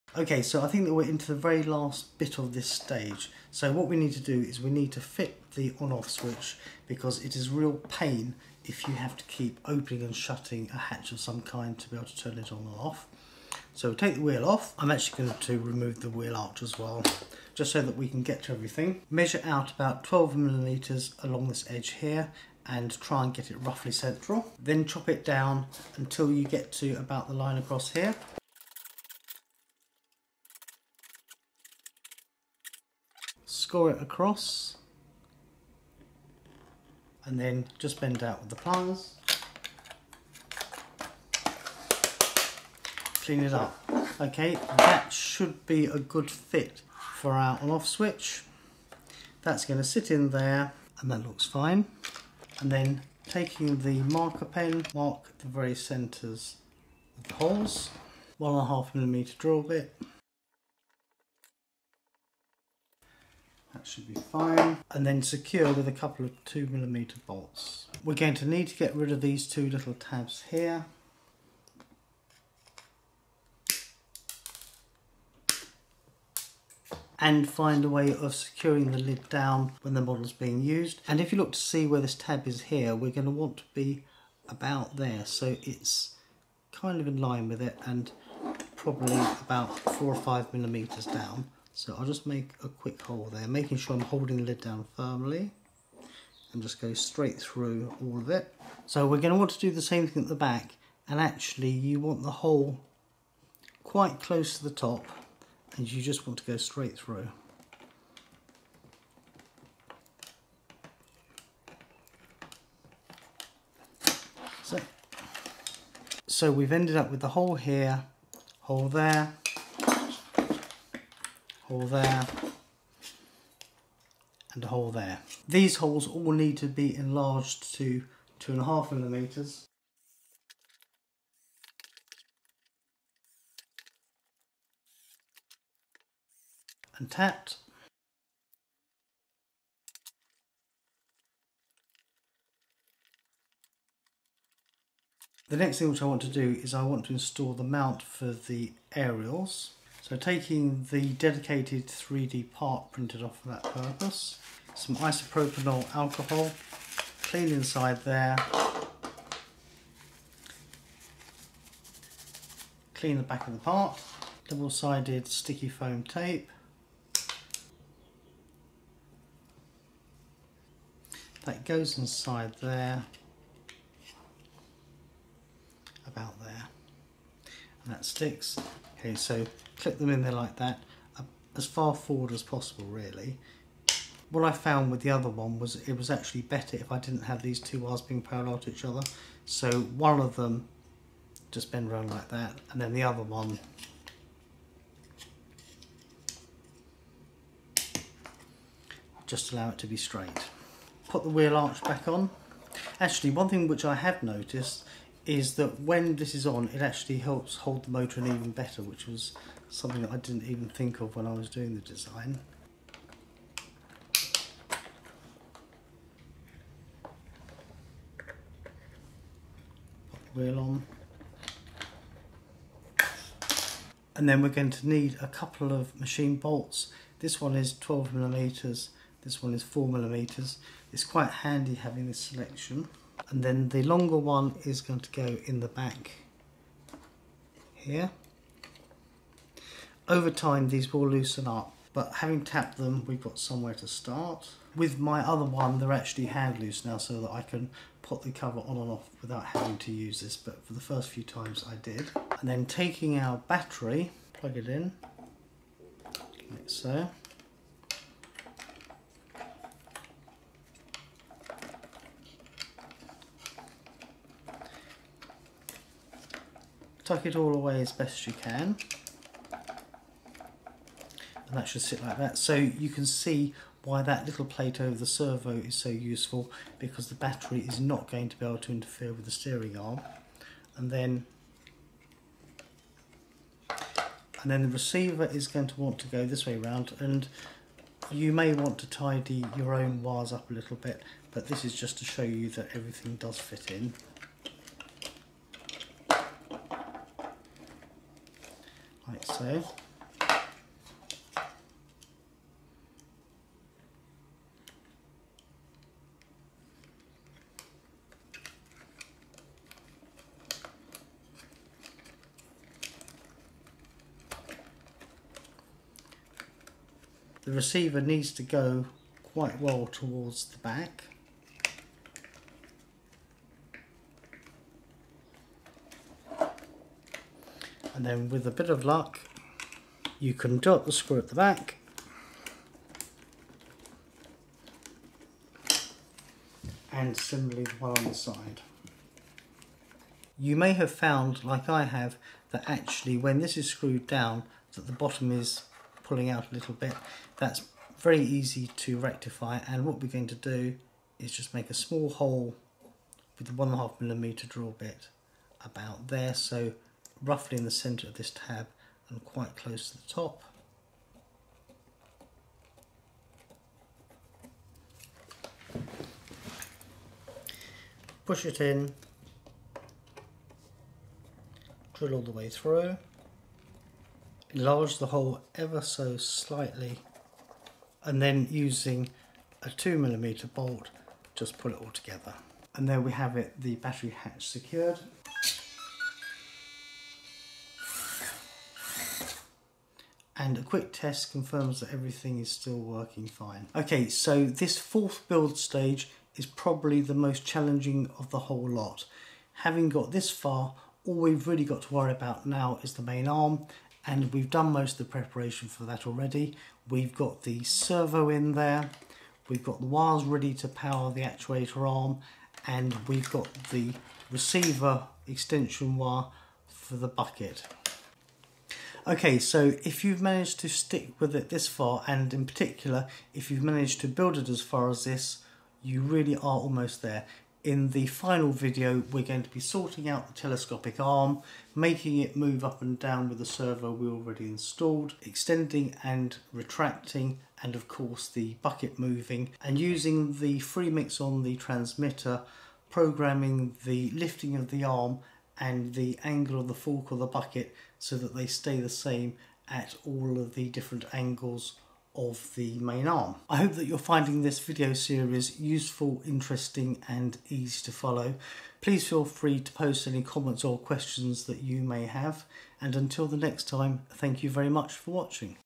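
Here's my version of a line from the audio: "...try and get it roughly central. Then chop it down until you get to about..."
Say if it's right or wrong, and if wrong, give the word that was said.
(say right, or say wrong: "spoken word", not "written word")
right.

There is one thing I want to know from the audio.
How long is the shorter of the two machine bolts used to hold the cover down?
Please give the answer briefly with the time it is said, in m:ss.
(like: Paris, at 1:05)
4 millimeters, at 3:49.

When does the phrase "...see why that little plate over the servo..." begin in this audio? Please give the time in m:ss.
4:33.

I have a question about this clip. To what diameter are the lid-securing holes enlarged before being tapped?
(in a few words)
2.5 millimeters.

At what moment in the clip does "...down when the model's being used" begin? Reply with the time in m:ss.
1:19.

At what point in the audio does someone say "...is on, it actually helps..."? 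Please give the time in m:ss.
3:26.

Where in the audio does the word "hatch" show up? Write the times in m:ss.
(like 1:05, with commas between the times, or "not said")
0:10, 6:24.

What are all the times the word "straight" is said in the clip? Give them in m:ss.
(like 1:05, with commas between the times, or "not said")
1:36, 1:46, 3:19.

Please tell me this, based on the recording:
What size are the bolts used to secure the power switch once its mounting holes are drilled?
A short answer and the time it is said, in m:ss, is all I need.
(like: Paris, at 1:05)
2 millimeter, at 1:06.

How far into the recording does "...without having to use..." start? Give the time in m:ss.
4:09.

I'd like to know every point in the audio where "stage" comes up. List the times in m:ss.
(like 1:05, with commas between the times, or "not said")
0:02, 6:35.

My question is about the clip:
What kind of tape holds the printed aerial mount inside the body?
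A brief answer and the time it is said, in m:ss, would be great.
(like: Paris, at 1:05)
double-sided sticky foam tape, at 2:44.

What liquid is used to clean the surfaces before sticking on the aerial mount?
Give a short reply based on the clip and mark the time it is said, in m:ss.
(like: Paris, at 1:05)
isopropanol alcohol, at 2:34.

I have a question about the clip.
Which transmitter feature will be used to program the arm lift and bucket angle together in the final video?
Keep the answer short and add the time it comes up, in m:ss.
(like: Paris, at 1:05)
Freemix, at 7:20.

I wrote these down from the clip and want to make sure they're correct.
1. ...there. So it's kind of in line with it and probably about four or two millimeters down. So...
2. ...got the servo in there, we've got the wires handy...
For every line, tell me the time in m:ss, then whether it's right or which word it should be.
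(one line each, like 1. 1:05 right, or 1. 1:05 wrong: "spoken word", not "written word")
1. 1:24 wrong: "five", not "two"
2. 6:47 wrong: "ready", not "handy".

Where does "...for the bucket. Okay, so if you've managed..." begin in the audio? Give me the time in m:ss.
6:56.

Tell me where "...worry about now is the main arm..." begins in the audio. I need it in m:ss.
6:41.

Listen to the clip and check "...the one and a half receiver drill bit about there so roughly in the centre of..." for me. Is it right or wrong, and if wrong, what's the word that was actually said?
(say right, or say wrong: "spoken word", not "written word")
wrong: "millimeter", not "receiver".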